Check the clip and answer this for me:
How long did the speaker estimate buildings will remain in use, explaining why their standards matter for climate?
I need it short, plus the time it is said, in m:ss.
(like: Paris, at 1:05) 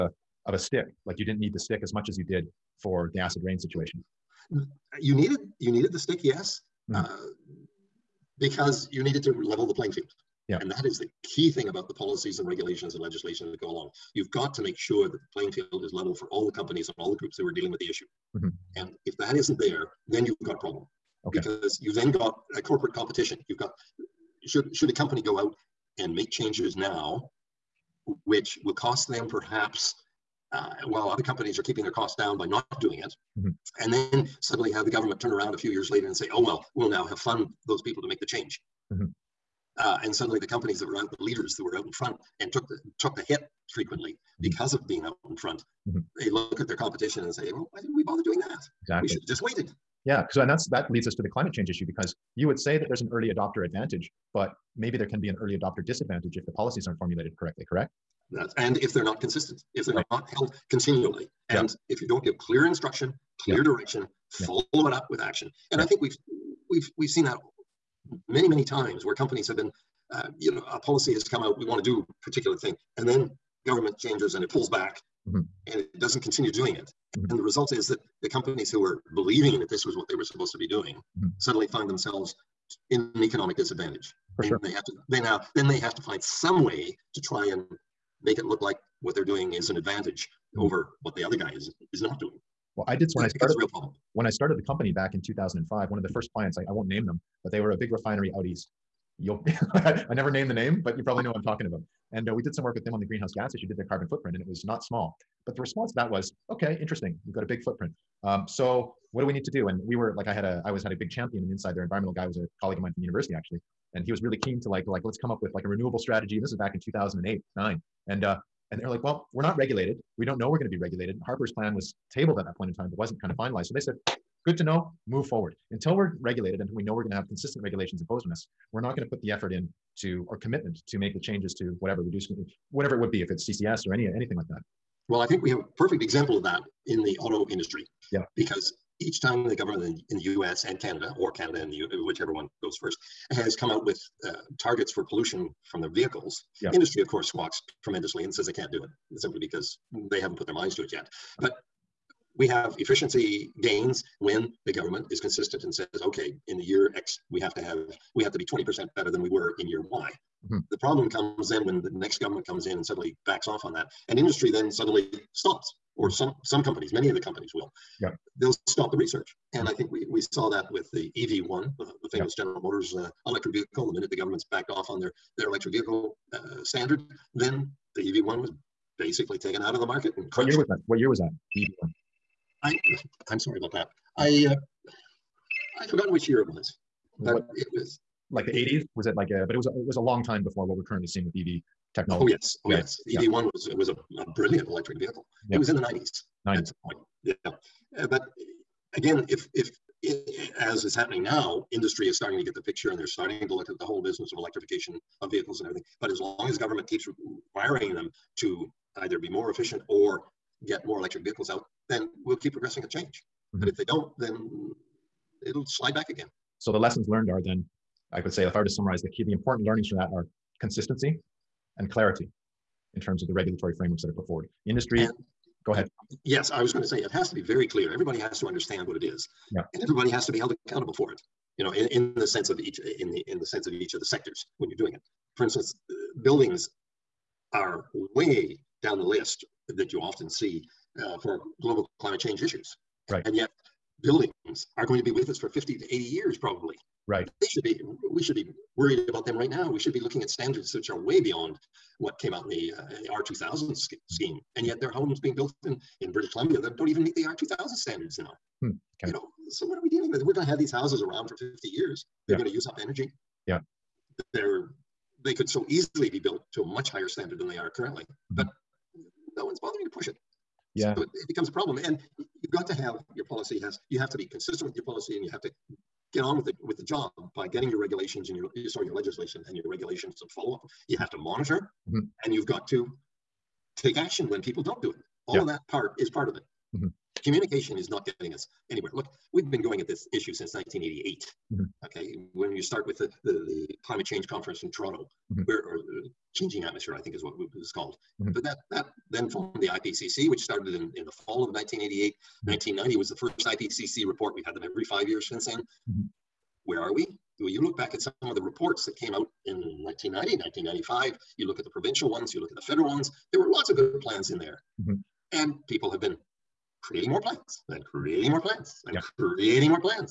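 50 to 80 years, at 4:05.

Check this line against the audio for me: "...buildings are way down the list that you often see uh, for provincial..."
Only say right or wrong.
wrong.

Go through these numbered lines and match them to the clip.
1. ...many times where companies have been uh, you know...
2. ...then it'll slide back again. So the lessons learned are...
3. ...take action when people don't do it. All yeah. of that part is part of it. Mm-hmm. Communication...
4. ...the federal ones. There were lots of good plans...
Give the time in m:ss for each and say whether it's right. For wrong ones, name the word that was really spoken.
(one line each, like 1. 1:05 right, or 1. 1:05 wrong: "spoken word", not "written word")
1. 1:08 right
2. 3:34 right
3. 4:43 right
4. 5:12 right.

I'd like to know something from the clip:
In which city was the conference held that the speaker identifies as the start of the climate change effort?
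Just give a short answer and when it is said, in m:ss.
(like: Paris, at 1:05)
Toronto, at 4:54.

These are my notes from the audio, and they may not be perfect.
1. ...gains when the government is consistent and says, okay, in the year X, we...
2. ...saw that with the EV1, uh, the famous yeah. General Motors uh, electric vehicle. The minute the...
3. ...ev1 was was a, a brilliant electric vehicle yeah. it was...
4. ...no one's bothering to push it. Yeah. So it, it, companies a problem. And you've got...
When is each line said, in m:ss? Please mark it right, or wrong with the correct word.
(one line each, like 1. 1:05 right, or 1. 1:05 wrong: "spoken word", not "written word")
1. 2:33 right
2. 2:50 right
3. 3:13 right
4. 4:29 wrong: "becomes", not "companies".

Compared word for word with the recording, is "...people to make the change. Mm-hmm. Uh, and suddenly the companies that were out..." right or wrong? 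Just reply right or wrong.
right.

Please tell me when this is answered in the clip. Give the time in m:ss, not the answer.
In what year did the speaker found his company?
1:35.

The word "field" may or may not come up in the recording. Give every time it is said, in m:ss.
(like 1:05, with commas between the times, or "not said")
0:09, 0:15.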